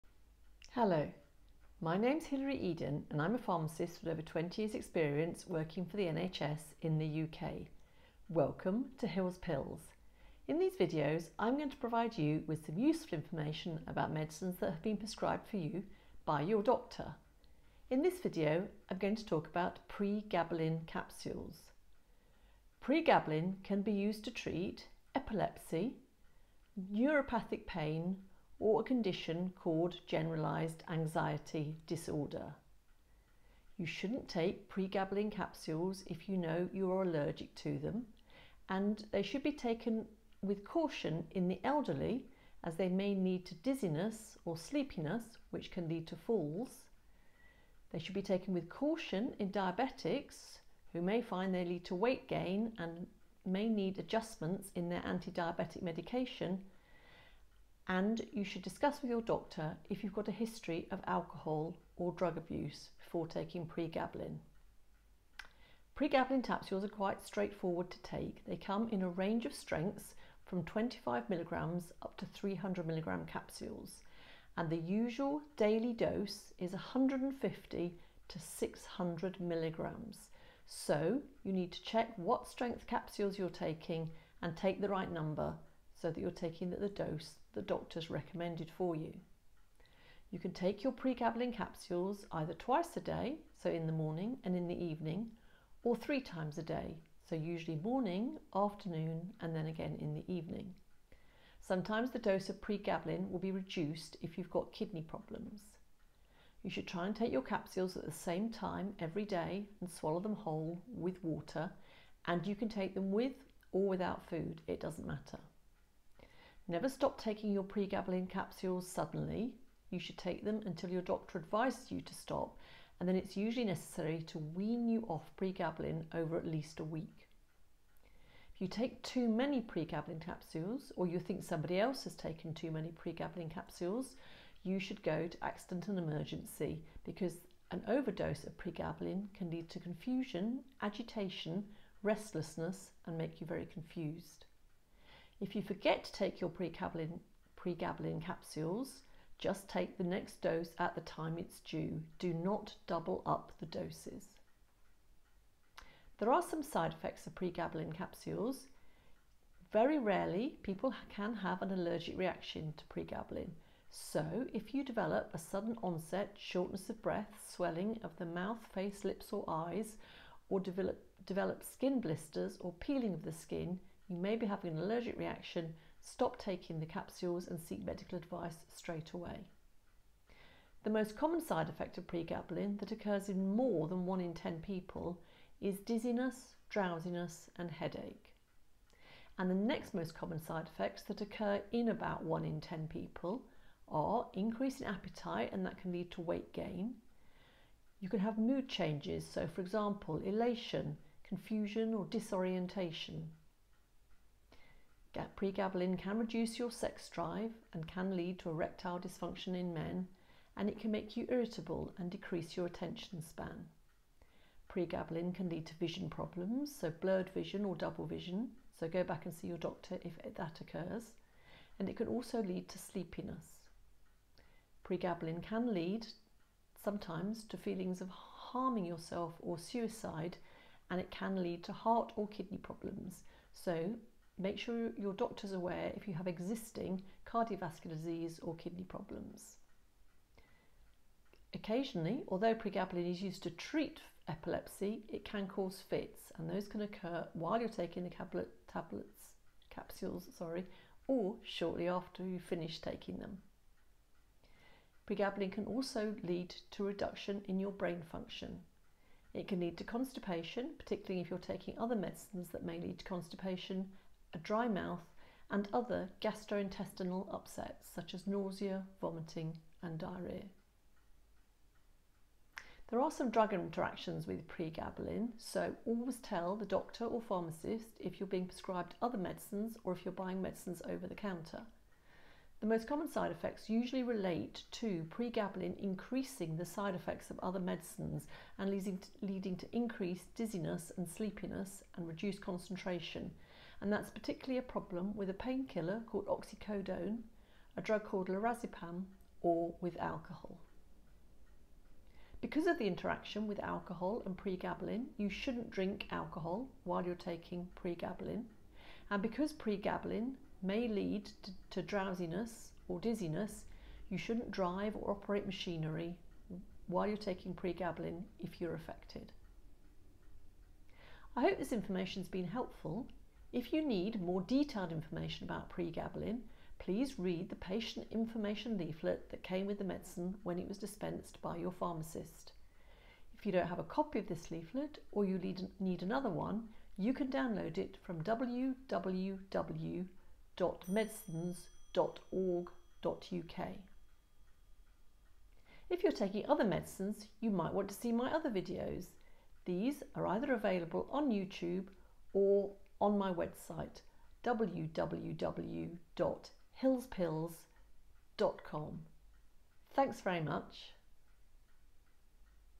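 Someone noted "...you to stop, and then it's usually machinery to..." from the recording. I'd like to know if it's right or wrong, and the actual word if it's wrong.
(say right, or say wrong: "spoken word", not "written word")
wrong: "necessary", not "machinery".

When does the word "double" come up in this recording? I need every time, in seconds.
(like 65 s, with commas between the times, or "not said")
152 s, 217 s.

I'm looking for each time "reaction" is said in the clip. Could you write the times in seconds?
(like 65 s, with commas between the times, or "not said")
162 s, 175 s.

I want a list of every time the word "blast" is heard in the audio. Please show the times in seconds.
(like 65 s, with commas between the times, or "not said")
not said.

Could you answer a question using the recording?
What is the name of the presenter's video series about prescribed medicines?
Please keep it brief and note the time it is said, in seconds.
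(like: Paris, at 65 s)
Hil's Pills, at 9 s.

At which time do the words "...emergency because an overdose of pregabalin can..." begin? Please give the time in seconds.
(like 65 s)
135 s.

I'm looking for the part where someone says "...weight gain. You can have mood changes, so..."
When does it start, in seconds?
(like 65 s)
196 s.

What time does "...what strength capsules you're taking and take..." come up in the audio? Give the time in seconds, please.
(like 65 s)
82 s.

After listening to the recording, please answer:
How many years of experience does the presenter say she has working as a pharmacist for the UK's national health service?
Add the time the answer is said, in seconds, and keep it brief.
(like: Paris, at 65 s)
over 20 years, at 4 s.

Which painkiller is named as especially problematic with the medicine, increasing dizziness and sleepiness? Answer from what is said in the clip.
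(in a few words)
oxycodone.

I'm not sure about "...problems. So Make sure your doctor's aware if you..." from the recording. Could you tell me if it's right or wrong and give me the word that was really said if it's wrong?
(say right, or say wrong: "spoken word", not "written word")
right.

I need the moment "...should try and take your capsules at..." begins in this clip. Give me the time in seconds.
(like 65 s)
106 s.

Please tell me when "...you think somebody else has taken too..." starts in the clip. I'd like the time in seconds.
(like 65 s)
131 s.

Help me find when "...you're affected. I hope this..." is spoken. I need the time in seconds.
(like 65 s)
318 s.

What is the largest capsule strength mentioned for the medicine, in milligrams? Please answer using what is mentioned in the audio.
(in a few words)
300 milligrams.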